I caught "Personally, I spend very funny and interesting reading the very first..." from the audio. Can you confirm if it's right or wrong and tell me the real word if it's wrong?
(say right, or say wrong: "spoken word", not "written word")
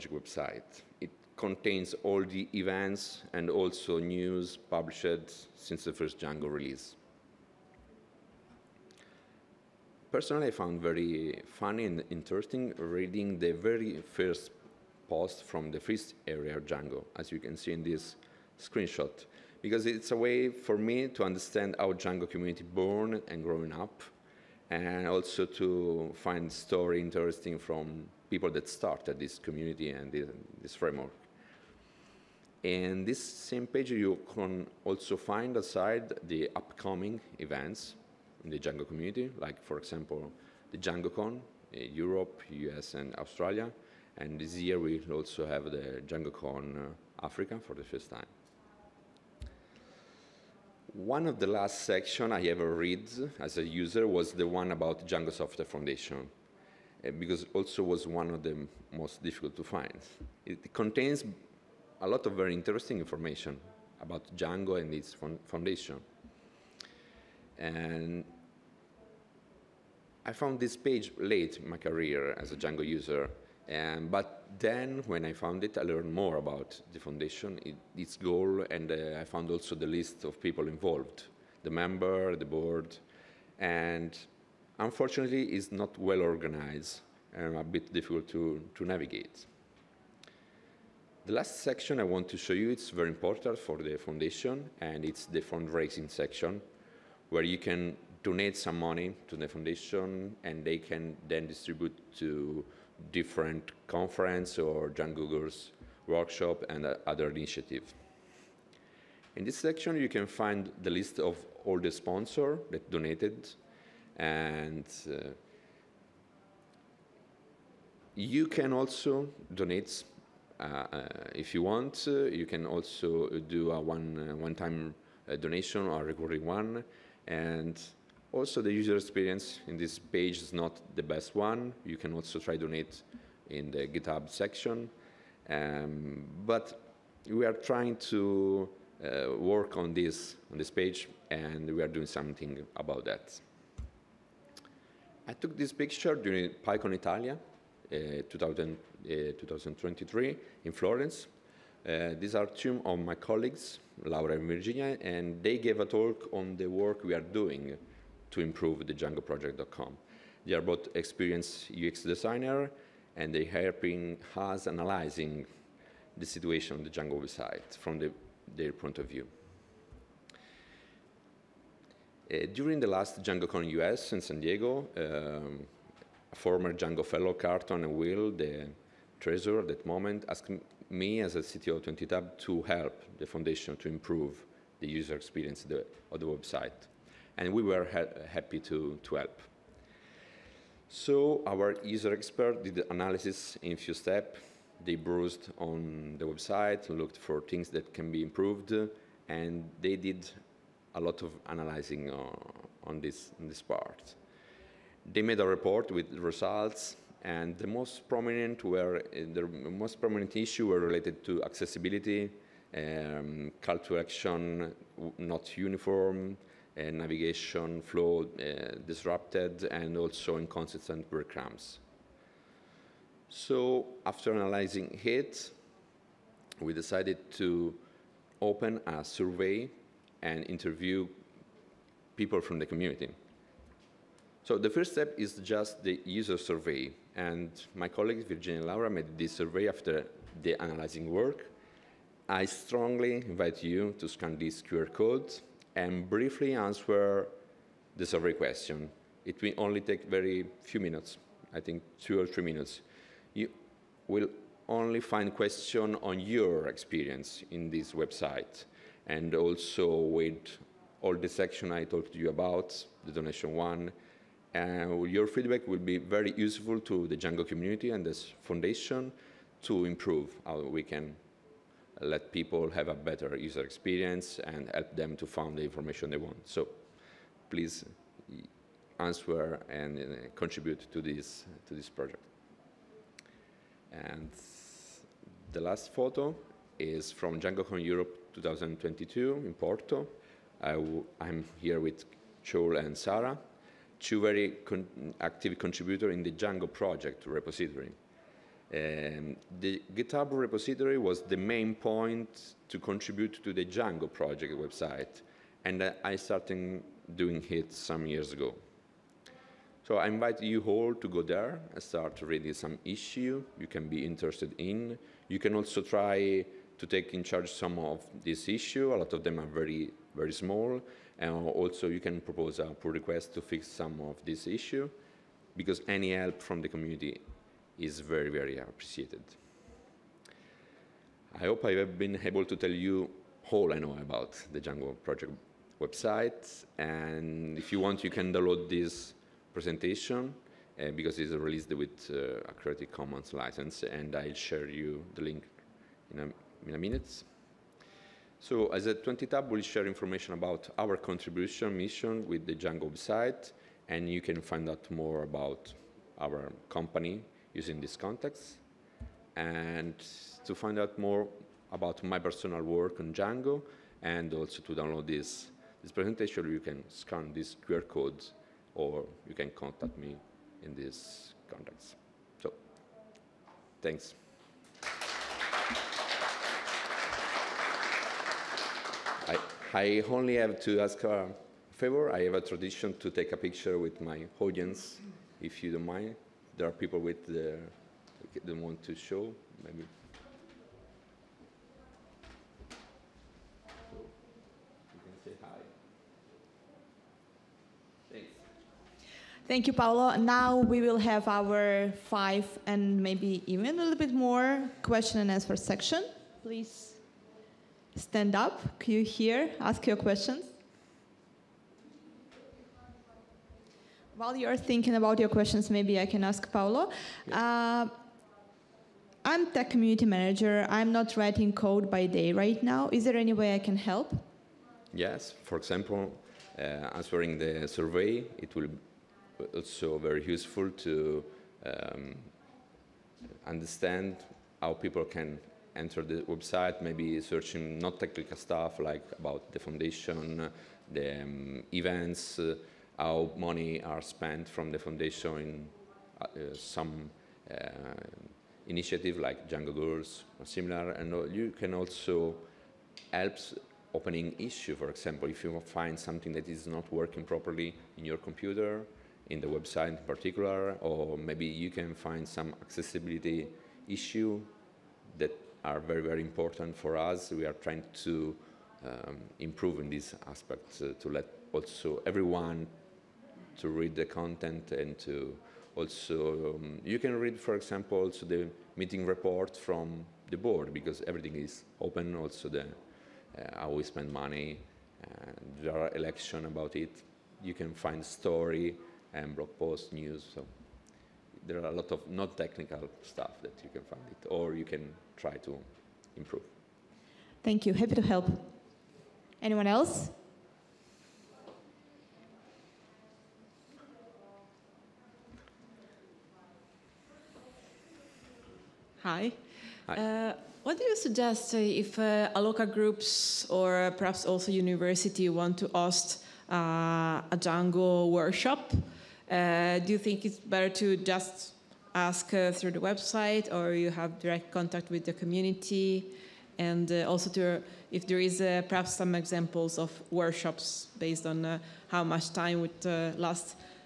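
wrong: "found", not "spend".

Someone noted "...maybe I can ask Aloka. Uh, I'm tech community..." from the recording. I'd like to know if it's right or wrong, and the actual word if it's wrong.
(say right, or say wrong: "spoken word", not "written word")
wrong: "Paolo", not "Aloka".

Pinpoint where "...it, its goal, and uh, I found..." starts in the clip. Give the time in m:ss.
1:17.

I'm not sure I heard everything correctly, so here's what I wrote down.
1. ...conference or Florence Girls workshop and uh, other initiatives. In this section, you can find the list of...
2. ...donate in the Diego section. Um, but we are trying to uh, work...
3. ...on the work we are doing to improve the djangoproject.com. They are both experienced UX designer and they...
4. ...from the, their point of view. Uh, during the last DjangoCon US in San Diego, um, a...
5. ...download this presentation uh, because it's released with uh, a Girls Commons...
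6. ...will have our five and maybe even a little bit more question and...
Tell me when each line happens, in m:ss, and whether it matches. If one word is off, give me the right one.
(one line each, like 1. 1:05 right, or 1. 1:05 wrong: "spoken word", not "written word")
1. 1:43 wrong: "Django", not "Florence"
2. 2:12 wrong: "GitHub", not "Diego"
3. 2:36 right
4. 2:47 right
5. 5:38 wrong: "Creative", not "Girls"
6. 6:40 right.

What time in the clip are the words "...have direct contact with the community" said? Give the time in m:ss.
8:43.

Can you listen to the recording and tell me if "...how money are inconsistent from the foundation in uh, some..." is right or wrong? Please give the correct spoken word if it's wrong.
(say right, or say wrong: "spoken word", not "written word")
wrong: "spent", not "inconsistent".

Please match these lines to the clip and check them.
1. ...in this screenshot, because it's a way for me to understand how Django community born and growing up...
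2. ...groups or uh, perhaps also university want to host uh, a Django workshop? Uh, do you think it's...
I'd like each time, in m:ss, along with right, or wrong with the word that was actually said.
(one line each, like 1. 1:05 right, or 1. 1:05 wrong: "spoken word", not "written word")
1. 0:17 right
2. 8:32 right.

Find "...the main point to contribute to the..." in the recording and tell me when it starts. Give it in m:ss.
5:01.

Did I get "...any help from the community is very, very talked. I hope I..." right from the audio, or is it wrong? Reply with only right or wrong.
wrong.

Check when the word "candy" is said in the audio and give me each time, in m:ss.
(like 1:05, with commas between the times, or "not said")
not said.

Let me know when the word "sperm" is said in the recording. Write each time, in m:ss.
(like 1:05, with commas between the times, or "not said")
not said.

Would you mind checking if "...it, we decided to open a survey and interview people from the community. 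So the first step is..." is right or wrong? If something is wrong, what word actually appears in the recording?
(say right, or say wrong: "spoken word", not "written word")
right.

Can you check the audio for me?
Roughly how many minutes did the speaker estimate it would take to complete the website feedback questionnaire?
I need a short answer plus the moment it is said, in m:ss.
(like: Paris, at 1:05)
2 or 3 minutes, at 4:12.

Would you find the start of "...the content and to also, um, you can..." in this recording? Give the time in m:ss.
7:53.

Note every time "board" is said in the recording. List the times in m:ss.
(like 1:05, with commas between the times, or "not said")
1:22, 8:00.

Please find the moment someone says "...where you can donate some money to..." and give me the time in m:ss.
1:37.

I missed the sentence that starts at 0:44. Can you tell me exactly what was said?
And this year, we also have the DjangoCon uh, Africa for the first time.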